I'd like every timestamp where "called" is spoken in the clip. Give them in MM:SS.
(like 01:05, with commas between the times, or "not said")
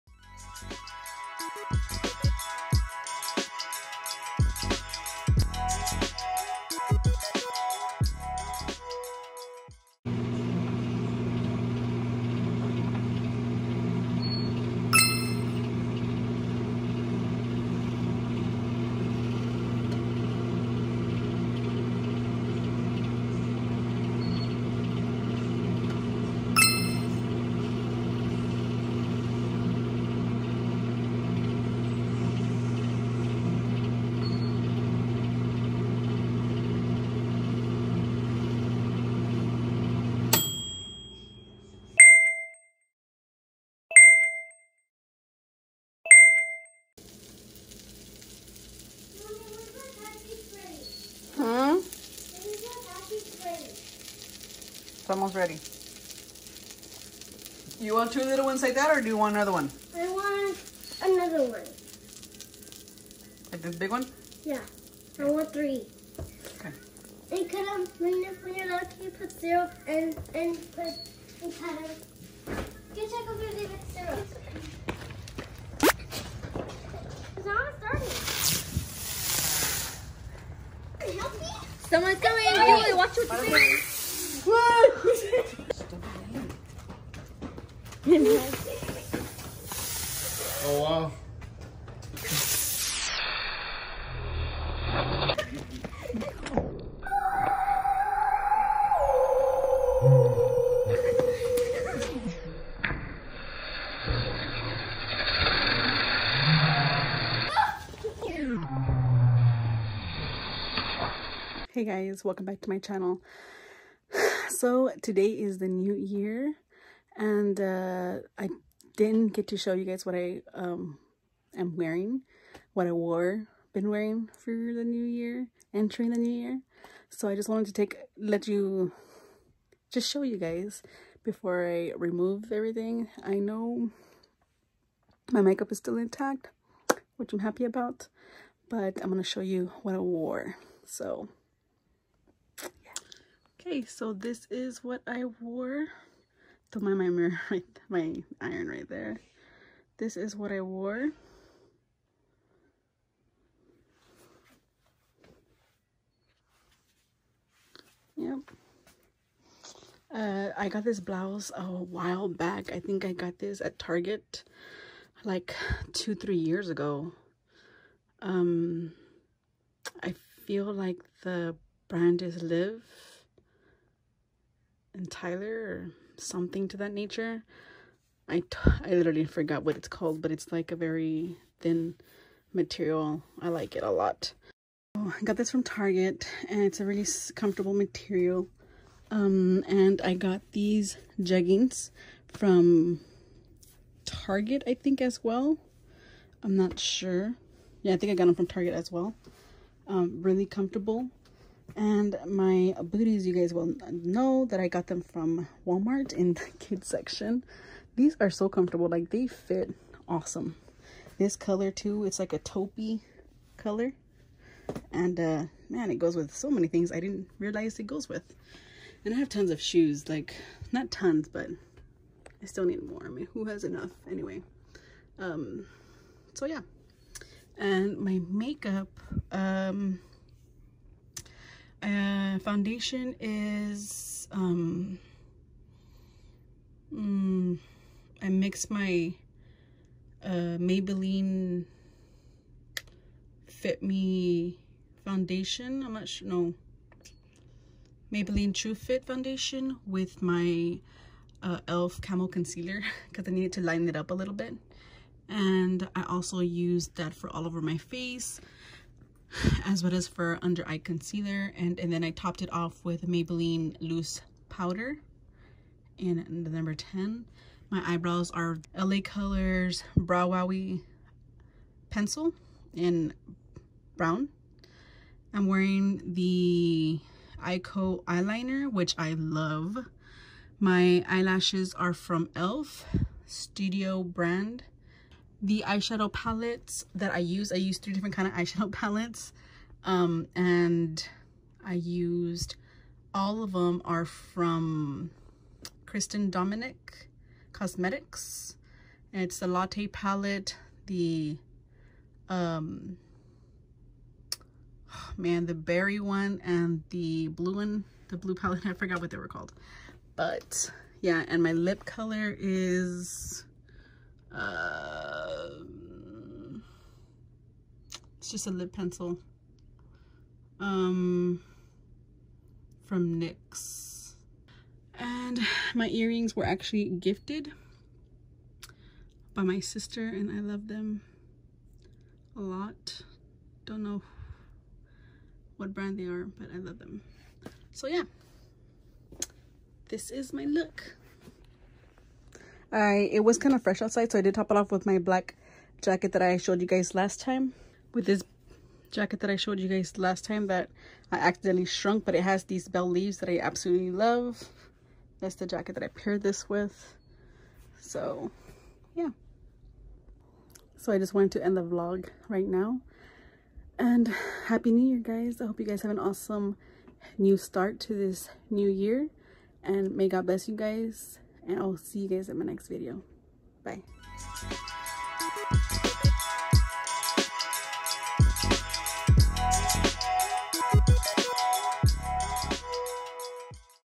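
02:59, 05:09.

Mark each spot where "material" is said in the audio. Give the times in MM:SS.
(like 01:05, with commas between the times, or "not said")
03:02, 03:07.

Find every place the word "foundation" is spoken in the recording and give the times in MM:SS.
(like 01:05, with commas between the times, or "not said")
03:51, 04:05, 04:09.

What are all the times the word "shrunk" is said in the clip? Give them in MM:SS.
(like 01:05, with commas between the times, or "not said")
05:51.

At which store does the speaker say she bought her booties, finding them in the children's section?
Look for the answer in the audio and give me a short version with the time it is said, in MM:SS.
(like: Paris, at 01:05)
Walmart, at 03:25.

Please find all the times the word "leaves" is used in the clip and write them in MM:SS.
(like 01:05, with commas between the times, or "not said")
05:52.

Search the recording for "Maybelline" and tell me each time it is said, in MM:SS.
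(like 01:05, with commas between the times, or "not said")
04:00, 04:08, 04:23.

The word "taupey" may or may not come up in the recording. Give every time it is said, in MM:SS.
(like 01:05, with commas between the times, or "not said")
03:32.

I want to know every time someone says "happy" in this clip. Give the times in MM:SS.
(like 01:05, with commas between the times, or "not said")
02:17, 06:04.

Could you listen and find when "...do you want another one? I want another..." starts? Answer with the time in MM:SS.
00:59.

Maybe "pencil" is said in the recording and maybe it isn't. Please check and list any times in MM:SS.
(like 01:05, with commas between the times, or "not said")
04:31, 05:18.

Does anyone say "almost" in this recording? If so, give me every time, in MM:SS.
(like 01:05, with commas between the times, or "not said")
00:55.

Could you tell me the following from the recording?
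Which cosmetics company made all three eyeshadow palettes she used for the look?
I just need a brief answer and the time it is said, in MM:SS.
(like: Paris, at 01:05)
Kristen Dominic Cosmetics, at 04:55.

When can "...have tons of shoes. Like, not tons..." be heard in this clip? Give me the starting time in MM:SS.
03:39.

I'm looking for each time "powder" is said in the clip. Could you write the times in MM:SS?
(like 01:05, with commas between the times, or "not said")
01:11, 04:24.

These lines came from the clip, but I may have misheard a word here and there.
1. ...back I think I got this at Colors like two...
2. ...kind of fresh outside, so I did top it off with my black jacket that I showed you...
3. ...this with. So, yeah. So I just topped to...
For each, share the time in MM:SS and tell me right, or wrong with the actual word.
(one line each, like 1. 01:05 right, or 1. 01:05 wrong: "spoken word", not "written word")
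1. 02:42 wrong: "Target", not "Colors"
2. 05:43 right
3. 05:56 wrong: "wanted", not "topped".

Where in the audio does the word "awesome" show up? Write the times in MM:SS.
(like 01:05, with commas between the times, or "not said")
03:30, 06:05.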